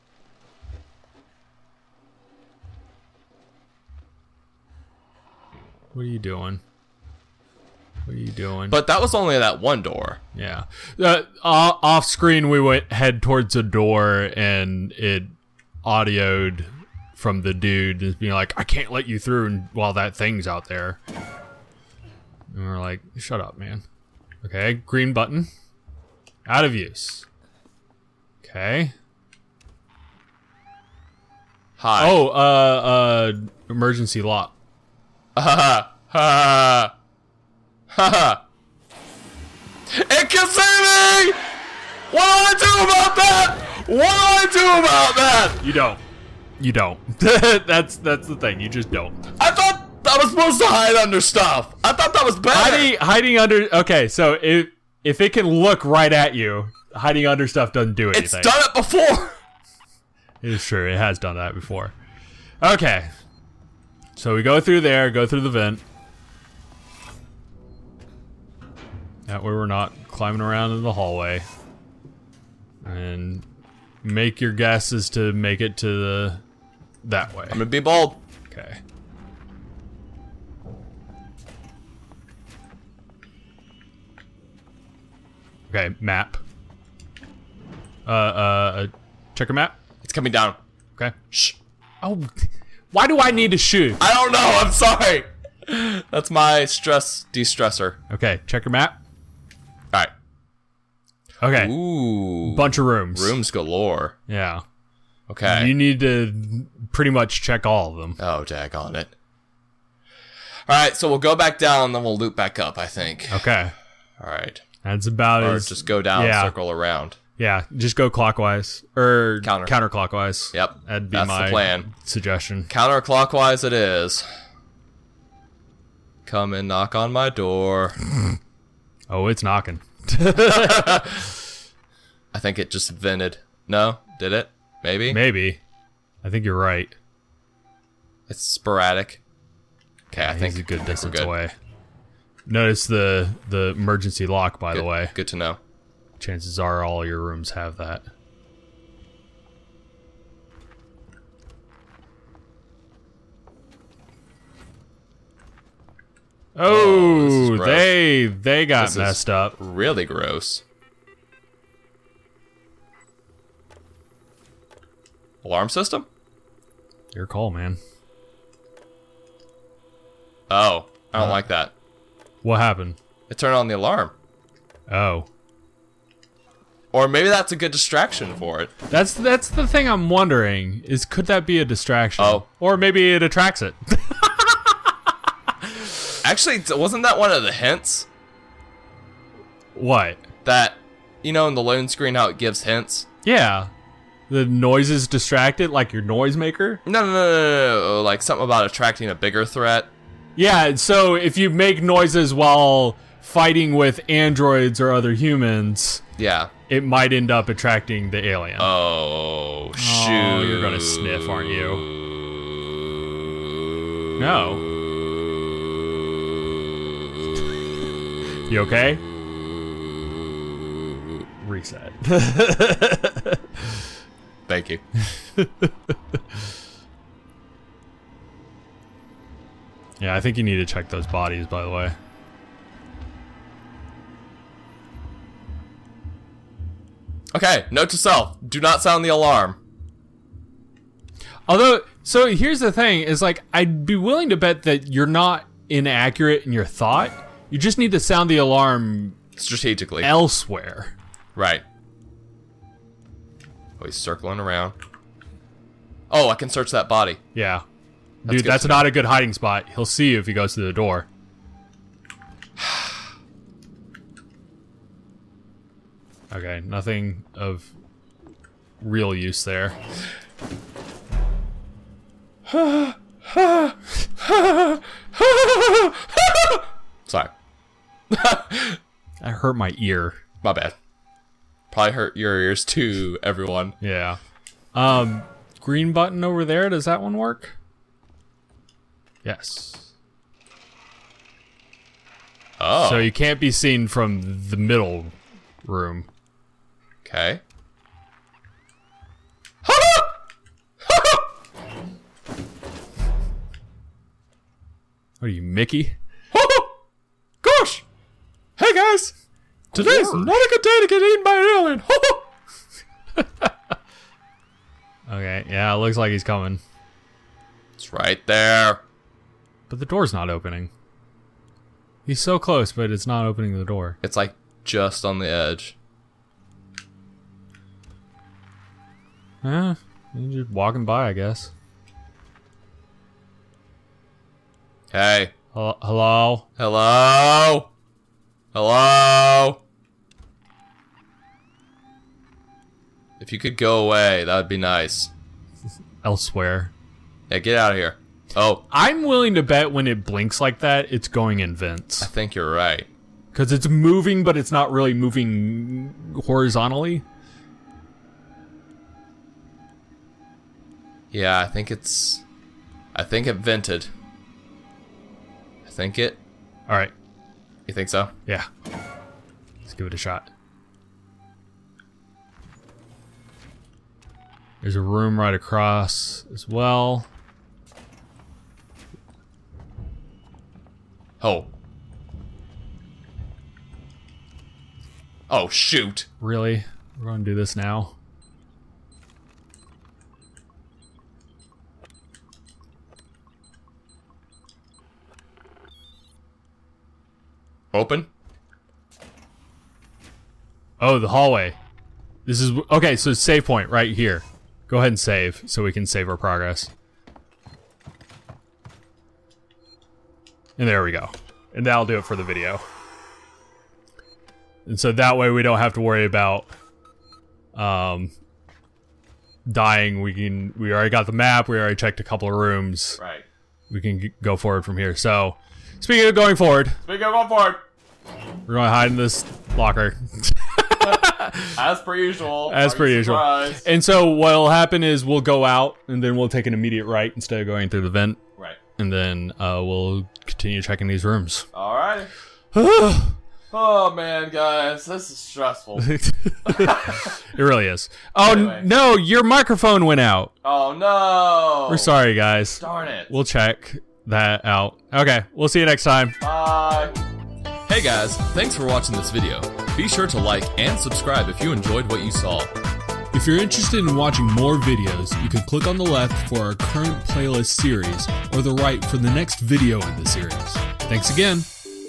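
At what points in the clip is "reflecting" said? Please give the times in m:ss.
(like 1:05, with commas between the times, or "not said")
not said.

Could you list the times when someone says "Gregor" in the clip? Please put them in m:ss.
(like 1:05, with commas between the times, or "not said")
not said.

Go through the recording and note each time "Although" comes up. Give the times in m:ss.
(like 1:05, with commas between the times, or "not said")
4:01.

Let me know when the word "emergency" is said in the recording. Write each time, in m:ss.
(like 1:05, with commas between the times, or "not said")
0:33, 2:23.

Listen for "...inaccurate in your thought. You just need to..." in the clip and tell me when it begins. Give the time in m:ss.
4:05.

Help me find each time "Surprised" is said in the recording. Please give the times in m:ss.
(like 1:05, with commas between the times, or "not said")
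7:13.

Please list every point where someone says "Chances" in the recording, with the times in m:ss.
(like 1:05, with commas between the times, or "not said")
2:26.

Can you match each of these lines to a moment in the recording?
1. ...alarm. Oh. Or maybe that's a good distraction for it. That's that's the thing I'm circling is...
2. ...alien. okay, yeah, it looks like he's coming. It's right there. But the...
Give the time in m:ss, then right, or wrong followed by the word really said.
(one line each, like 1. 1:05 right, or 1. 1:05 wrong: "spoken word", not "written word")
1. 2:53 wrong: "wondering", not "circling"
2. 5:13 right.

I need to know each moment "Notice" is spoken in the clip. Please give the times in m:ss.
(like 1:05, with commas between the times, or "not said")
2:22.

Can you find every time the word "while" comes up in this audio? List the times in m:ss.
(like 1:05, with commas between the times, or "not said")
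0:19, 3:22.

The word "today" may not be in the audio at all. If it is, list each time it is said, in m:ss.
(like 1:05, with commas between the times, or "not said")
5:09.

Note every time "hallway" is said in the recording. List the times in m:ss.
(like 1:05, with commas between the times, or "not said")
1:10, 6:41.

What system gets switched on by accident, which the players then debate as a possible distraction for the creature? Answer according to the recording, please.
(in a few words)
Alarm system.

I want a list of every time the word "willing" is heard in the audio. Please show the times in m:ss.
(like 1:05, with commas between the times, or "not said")
4:03, 5:49.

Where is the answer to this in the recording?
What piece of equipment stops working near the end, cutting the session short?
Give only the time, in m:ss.
7:28.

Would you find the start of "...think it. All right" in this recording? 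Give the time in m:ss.
6:05.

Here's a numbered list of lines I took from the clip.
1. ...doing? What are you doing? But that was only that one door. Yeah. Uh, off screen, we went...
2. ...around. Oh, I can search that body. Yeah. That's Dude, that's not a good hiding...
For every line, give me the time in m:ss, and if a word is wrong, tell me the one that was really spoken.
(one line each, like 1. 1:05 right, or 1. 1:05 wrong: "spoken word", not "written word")
1. 0:06 right
2. 4:14 right.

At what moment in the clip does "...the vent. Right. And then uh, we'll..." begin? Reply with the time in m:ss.
7:17.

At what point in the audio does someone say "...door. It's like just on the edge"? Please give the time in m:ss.
5:23.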